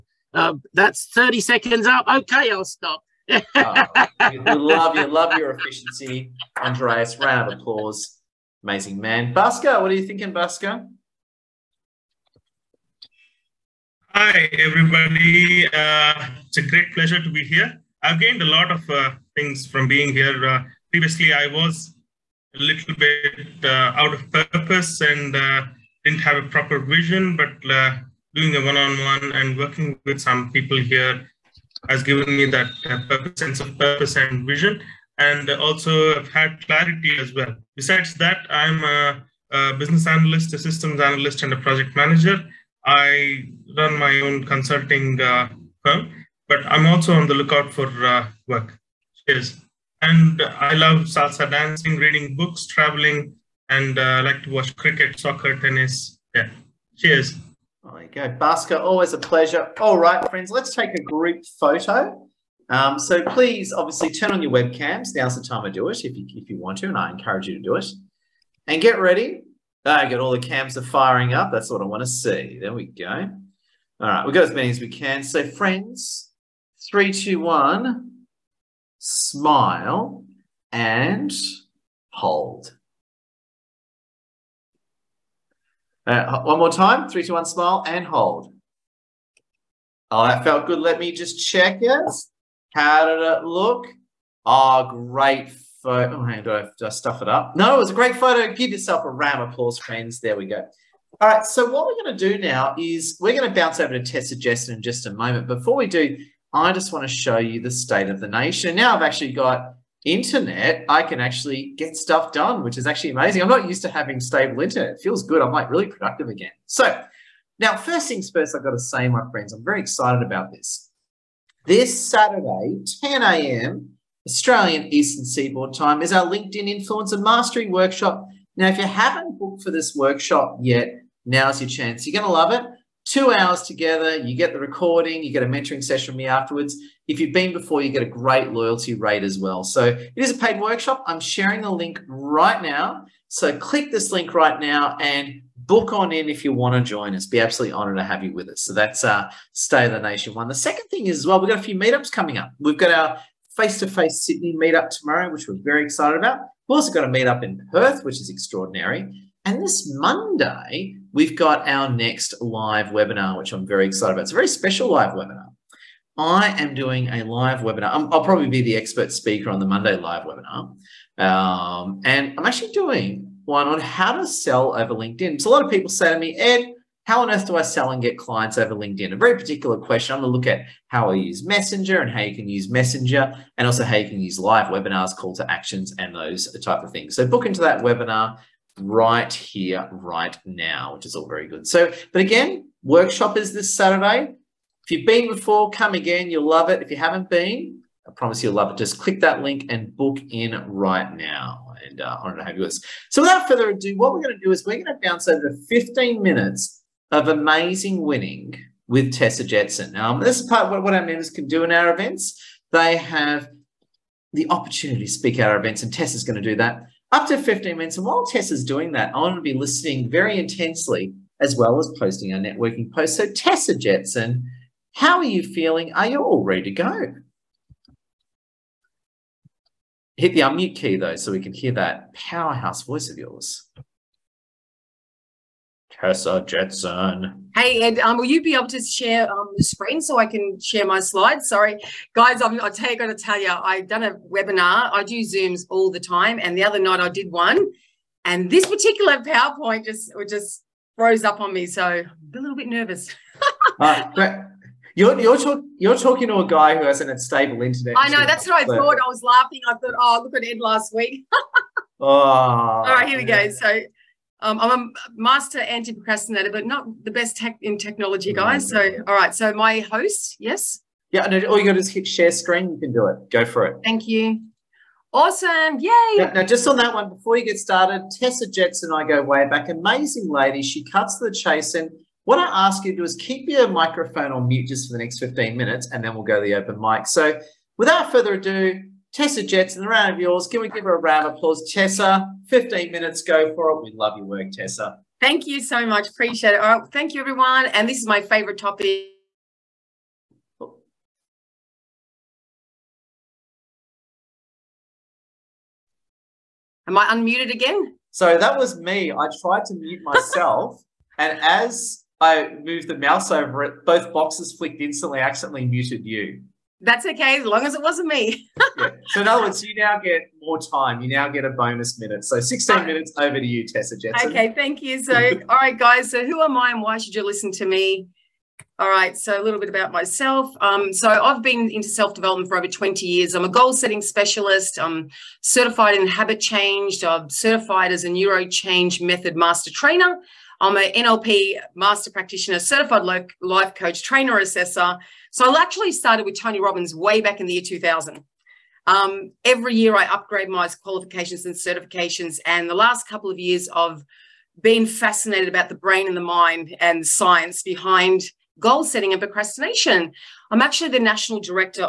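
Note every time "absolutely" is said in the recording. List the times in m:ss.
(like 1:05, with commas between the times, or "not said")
2:27.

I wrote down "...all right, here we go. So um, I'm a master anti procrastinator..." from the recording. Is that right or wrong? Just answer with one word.
right.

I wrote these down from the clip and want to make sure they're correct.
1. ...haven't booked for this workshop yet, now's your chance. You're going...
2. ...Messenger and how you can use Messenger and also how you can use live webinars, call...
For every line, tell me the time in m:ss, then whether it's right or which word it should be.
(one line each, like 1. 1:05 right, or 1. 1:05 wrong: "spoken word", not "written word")
1. 2:08 right
2. 3:01 right.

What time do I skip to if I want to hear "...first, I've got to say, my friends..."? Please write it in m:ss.
1:58.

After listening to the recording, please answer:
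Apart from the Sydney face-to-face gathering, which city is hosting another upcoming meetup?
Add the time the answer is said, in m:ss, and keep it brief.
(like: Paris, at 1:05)
Perth, at 2:37.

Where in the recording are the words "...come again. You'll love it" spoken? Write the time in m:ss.
3:15.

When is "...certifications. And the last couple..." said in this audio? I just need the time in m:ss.
5:51.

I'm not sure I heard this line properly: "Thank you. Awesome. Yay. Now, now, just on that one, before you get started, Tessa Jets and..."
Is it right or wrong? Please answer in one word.
right.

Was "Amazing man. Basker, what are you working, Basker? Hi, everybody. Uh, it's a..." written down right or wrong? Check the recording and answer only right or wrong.
wrong.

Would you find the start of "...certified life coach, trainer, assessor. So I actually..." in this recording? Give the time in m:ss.
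5:42.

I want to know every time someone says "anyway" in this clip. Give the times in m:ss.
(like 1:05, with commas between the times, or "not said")
not said.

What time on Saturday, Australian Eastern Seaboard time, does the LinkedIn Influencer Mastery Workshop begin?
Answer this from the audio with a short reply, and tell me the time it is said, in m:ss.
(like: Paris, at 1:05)
10 a.m., at 2:03.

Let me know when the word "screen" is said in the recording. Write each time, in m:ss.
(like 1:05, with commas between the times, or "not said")
3:59, 4:32.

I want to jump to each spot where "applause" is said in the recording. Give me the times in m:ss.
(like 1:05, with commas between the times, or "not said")
0:07, 1:39, 4:51.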